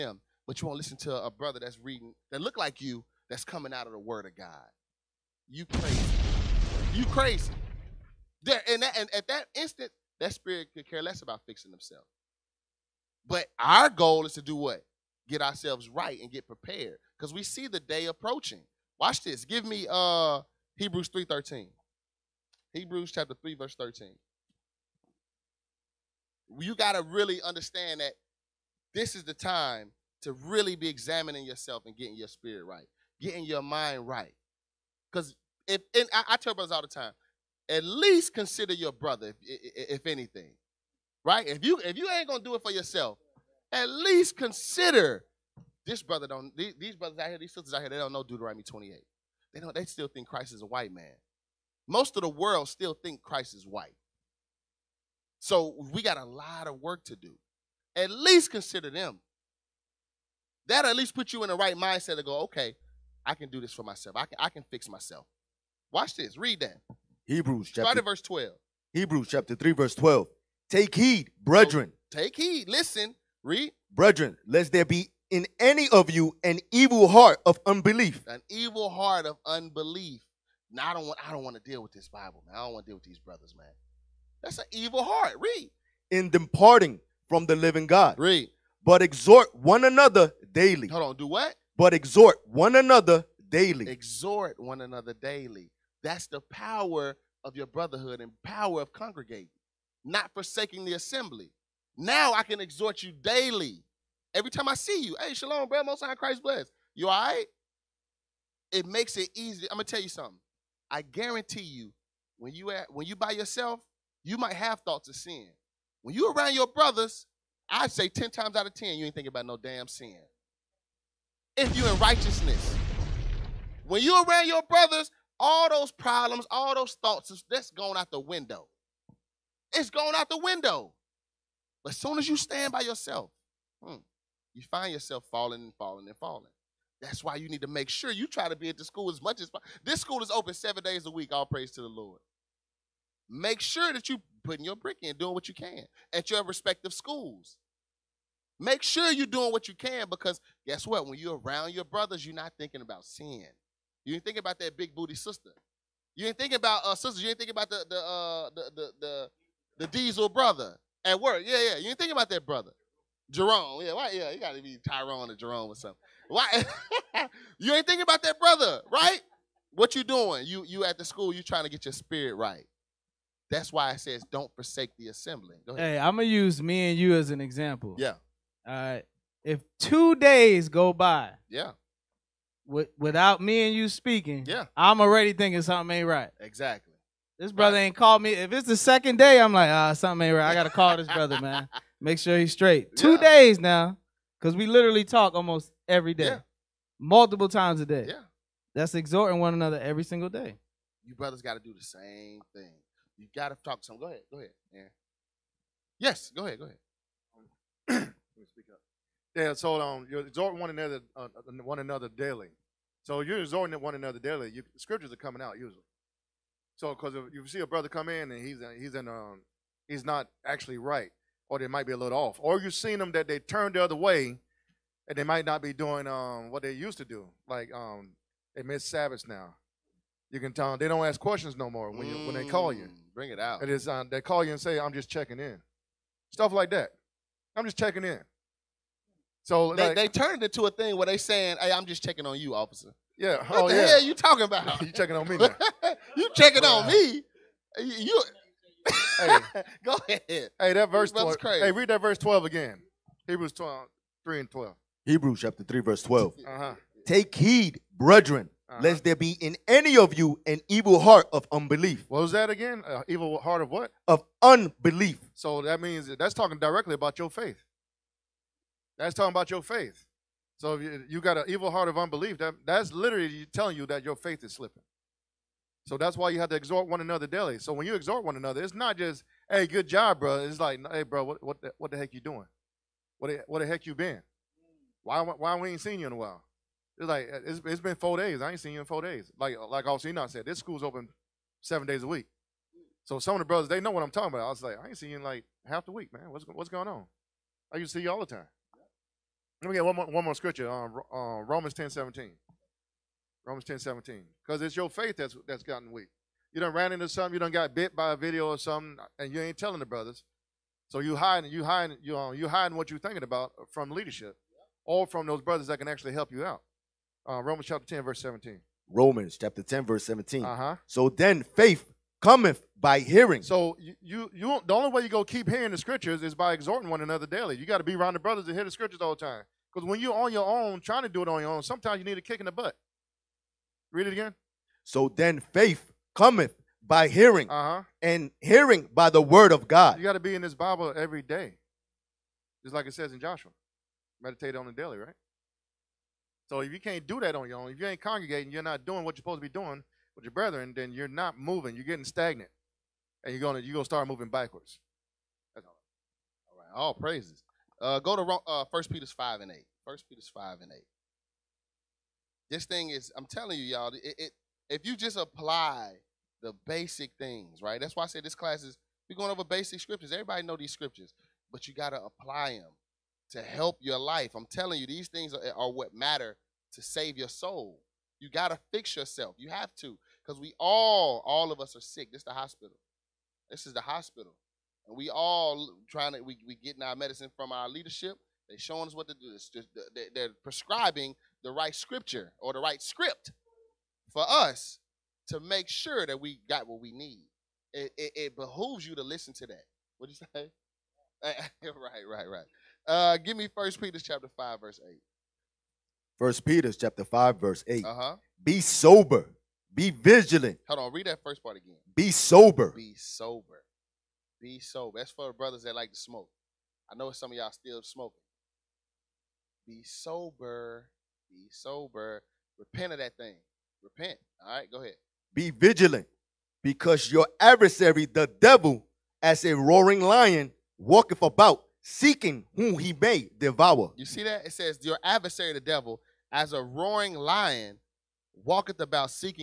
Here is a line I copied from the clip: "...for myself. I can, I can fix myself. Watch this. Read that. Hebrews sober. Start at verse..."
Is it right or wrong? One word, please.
wrong.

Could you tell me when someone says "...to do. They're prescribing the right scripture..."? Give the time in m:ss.
6:29.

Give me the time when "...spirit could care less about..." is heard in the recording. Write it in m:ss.
0:10.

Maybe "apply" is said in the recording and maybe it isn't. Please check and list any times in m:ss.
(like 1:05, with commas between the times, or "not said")
6:05, 6:12.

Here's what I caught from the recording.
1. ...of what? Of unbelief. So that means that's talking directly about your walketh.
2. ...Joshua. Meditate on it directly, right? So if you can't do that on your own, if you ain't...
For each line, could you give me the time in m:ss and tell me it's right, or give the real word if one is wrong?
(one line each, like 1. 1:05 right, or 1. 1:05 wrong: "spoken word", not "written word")
1. 4:23 wrong: "faith", not "walketh"
2. 5:43 wrong: "daily", not "directly".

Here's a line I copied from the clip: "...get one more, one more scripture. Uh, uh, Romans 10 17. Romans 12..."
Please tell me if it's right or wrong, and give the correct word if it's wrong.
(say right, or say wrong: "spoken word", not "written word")
wrong: "10", not "12".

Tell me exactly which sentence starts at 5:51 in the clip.
You're getting stagnant, and you're gonna you're gonna start moving backwards.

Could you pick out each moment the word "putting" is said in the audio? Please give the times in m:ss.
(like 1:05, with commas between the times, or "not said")
2:24.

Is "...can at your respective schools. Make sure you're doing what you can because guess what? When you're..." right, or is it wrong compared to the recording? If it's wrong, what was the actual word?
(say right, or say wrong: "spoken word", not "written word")
right.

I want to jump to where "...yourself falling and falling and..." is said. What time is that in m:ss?
2:14.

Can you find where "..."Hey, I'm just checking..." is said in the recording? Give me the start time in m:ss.
4:01.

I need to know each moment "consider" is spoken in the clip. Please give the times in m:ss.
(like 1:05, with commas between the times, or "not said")
0:38, 0:44, 0:58.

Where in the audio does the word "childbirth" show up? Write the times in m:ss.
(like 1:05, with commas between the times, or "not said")
not said.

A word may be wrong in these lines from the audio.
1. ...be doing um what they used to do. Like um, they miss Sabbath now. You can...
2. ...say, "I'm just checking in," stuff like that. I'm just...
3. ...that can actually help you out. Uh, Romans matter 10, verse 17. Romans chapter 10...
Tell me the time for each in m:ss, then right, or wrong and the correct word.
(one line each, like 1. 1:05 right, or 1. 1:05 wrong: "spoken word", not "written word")
1. 3:45 right
2. 3:54 right
3. 5:15 wrong: "chapter", not "matter".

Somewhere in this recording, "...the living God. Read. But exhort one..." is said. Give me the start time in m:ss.
1:27.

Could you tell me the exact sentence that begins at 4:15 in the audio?
Hebrews chapter three, verse 12 uh-huh.